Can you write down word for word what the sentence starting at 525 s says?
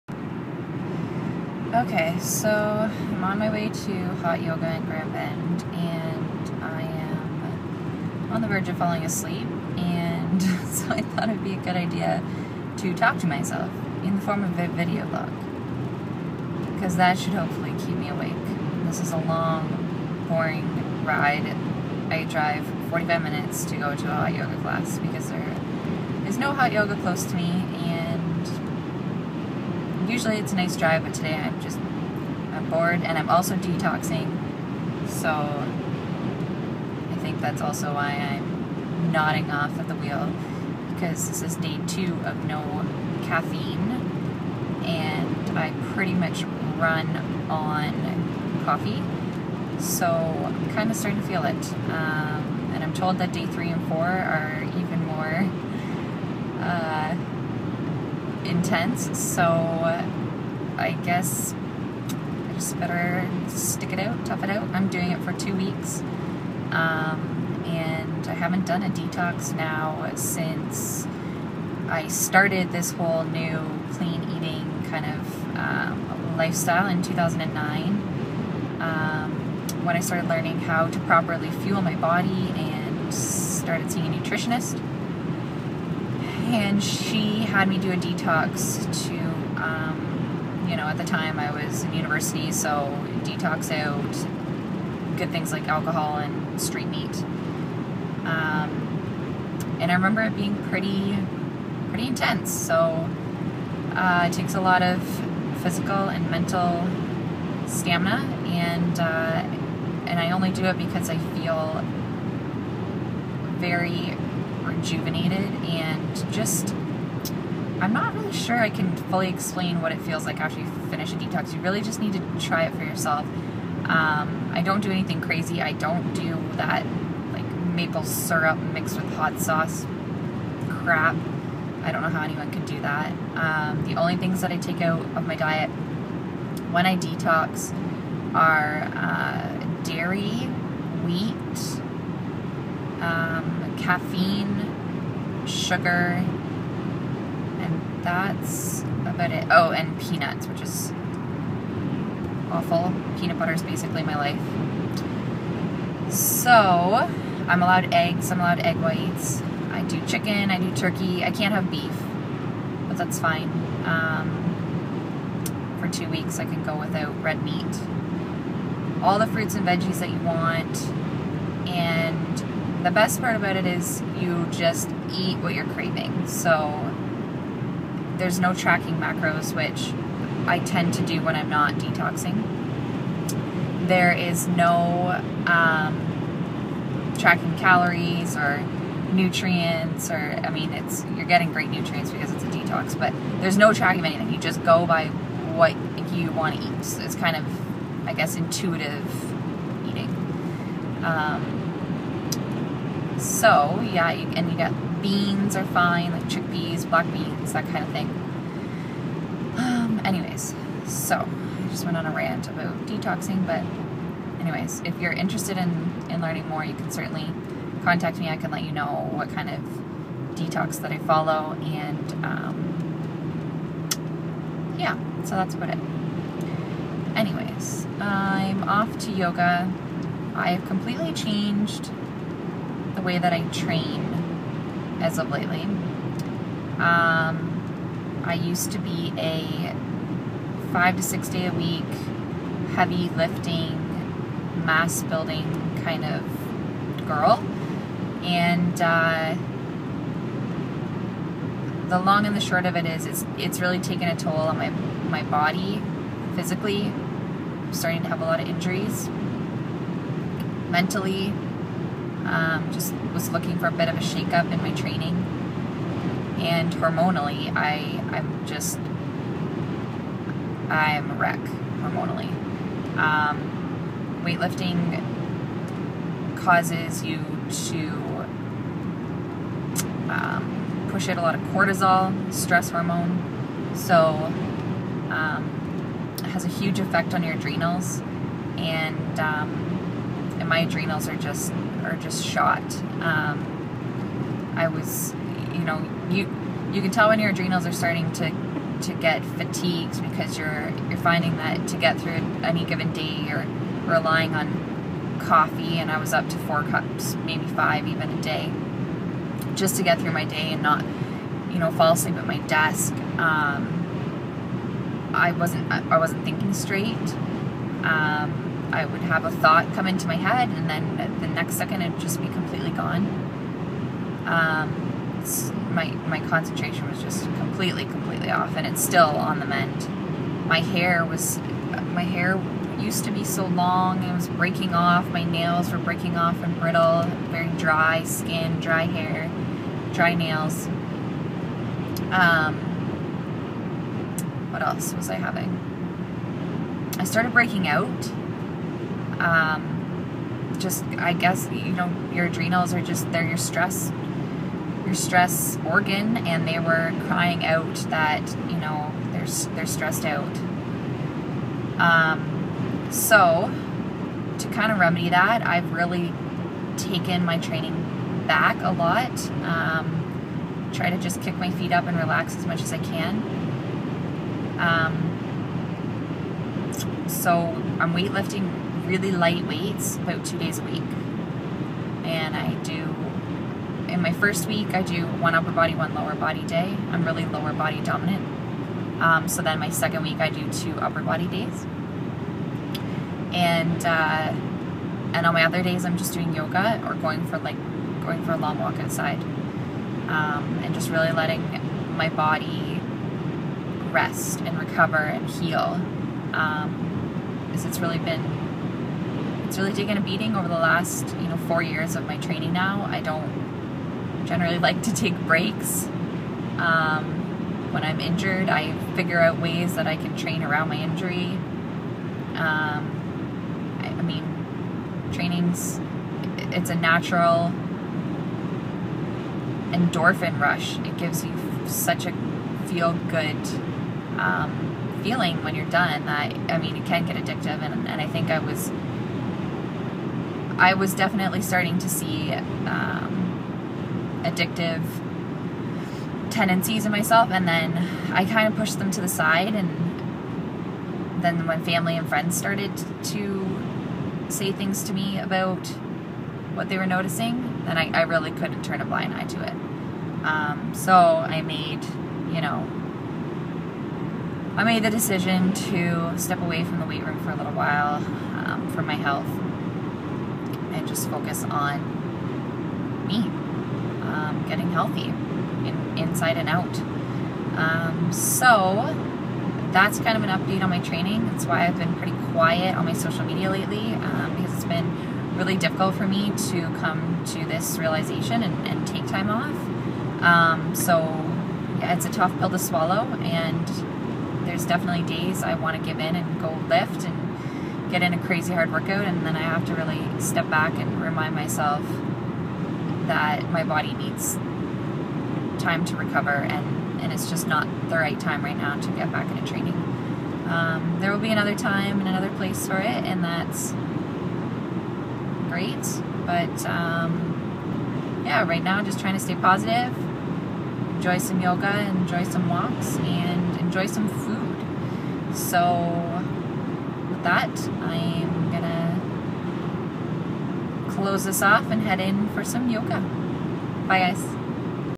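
So that, I'm gonna close this off and head in for some yoga.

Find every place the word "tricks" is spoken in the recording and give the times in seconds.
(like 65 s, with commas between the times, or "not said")
not said.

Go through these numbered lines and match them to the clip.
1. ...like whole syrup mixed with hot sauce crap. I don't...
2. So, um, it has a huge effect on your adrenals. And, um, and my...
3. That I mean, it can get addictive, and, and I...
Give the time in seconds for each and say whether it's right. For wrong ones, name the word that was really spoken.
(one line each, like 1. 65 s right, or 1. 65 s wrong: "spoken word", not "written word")
1. 127 s wrong: "maple", not "whole"
2. 283 s right
3. 436 s right.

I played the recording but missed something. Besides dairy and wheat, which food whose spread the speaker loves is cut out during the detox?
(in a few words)
peanuts.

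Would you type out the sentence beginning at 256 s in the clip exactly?
I'm starting to have a lot of injuries mentally um, just was looking for a bit of a shakeup in my training.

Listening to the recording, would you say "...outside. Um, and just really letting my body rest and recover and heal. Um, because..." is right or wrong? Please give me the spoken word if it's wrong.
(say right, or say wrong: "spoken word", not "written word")
right.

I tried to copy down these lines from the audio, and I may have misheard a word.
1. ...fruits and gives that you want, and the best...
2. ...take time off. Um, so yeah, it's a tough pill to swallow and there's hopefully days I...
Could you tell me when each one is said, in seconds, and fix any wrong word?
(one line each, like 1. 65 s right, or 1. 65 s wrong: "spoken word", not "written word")
1. 169 s wrong: "veggies", not "gives"
2. 488 s wrong: "definitely", not "hopefully".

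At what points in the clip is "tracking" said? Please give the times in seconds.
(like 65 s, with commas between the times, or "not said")
178 s, 187 s, 193 s.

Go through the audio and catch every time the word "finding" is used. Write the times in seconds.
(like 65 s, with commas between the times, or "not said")
300 s.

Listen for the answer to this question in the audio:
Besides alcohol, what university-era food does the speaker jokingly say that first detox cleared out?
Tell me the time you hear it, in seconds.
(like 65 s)
96 s.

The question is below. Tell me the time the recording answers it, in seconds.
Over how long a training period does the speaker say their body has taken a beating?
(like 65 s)
411 s.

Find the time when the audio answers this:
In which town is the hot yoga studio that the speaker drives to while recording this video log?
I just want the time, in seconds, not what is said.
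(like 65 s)
4 s.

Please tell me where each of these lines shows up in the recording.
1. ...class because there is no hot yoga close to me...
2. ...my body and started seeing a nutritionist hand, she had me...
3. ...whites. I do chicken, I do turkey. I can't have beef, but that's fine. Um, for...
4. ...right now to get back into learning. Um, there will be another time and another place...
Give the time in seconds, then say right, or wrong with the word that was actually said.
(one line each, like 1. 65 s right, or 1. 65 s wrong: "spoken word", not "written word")
1. 24 s right
2. 81 s right
3. 158 s right
4. 508 s wrong: "training", not "learning".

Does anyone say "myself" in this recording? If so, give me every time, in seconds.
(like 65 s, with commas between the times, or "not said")
13 s, 446 s, 501 s.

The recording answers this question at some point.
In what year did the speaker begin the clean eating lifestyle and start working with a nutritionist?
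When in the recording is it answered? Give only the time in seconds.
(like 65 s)
77 s.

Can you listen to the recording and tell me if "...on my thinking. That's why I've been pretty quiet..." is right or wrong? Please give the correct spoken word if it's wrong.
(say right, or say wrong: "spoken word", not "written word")
wrong: "training", not "thinking".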